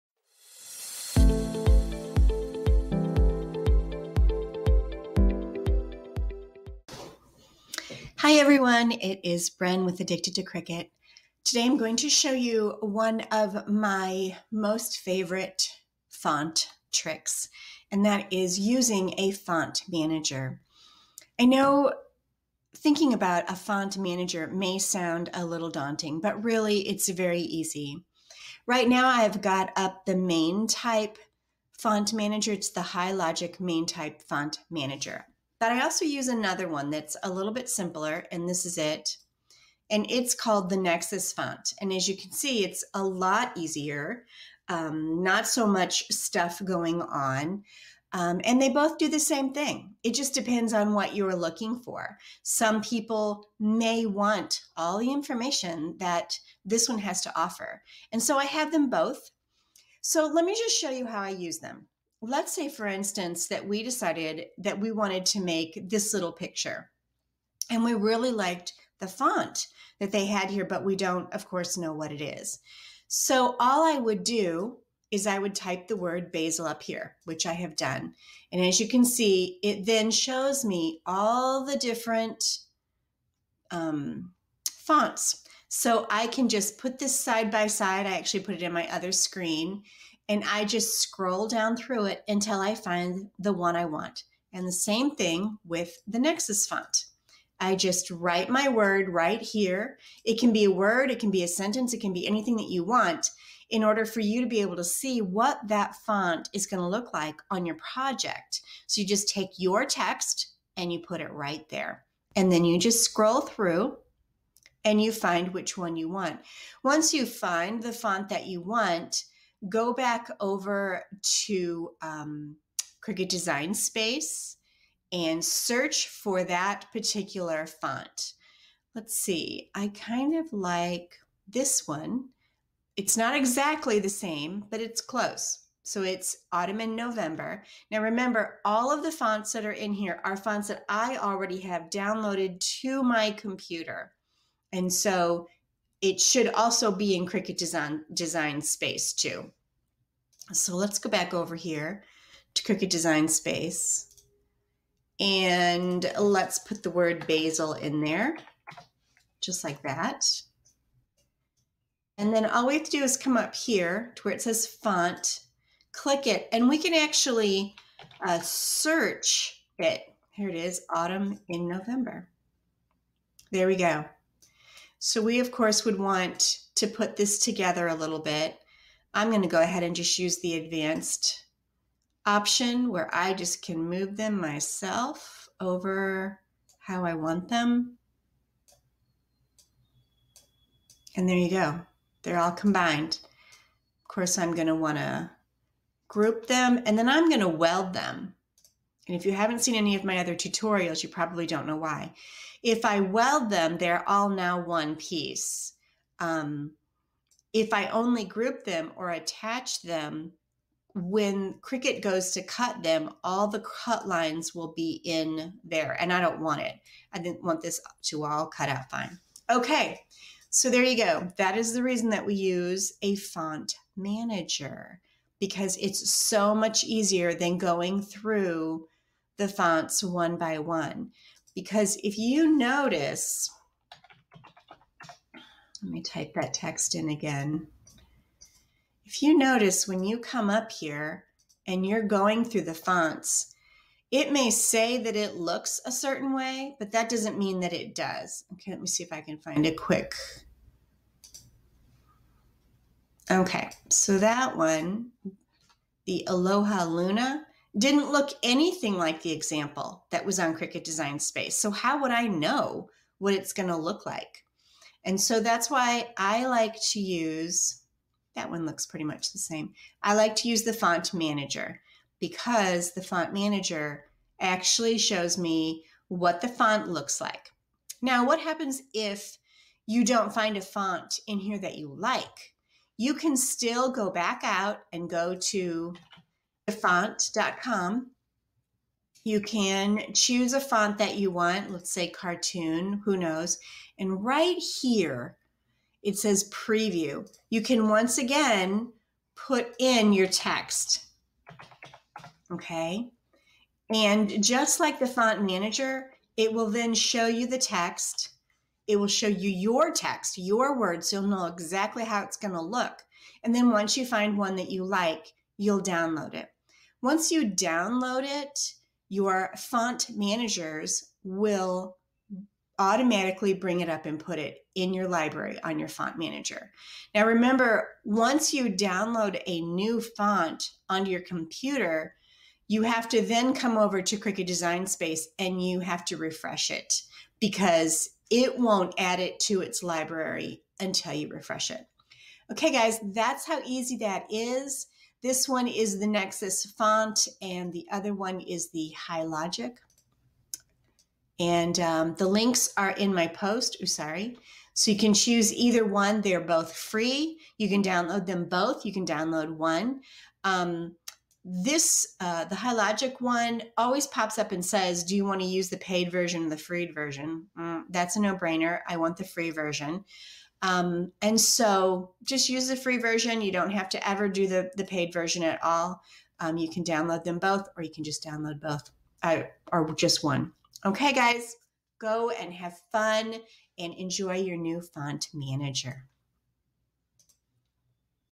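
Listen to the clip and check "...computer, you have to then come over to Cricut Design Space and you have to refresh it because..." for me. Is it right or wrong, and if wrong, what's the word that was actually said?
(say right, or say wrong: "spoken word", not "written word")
right.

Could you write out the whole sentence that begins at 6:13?
You don't have to ever do the, the paid version at all.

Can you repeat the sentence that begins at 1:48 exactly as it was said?
So you just take your text and you put it right there.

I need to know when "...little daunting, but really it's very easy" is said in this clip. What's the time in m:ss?
0:25.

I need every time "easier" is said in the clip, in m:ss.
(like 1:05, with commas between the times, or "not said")
0:43, 3:46.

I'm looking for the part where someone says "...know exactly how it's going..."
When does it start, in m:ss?
5:11.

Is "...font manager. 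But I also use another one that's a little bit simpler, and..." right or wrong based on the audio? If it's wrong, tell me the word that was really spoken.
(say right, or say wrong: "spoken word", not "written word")
right.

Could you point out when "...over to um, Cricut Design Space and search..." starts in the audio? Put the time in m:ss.
2:00.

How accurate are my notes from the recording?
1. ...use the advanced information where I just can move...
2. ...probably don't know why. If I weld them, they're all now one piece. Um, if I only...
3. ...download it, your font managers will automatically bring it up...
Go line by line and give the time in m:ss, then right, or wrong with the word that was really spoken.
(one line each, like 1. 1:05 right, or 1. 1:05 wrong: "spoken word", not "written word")
1. 3:00 wrong: "option", not "information"
2. 3:21 right
3. 5:17 right.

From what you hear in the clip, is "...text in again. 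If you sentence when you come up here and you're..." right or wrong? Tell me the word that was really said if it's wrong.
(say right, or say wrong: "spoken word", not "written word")
wrong: "notice", not "sentence".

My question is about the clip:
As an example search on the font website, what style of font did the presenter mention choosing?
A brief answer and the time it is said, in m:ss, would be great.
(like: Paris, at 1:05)
cartoon, at 4:52.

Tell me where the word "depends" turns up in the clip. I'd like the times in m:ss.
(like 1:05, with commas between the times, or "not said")
0:50.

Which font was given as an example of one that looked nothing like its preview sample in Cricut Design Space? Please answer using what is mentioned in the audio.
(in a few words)
Aloha Luna.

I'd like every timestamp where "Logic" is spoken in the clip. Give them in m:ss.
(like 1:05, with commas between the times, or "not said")
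0:33, 5:49, 6:02.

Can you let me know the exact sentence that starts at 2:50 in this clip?
Here it is, autumn in November.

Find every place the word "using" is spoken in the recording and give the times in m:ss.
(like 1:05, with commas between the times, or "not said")
0:18.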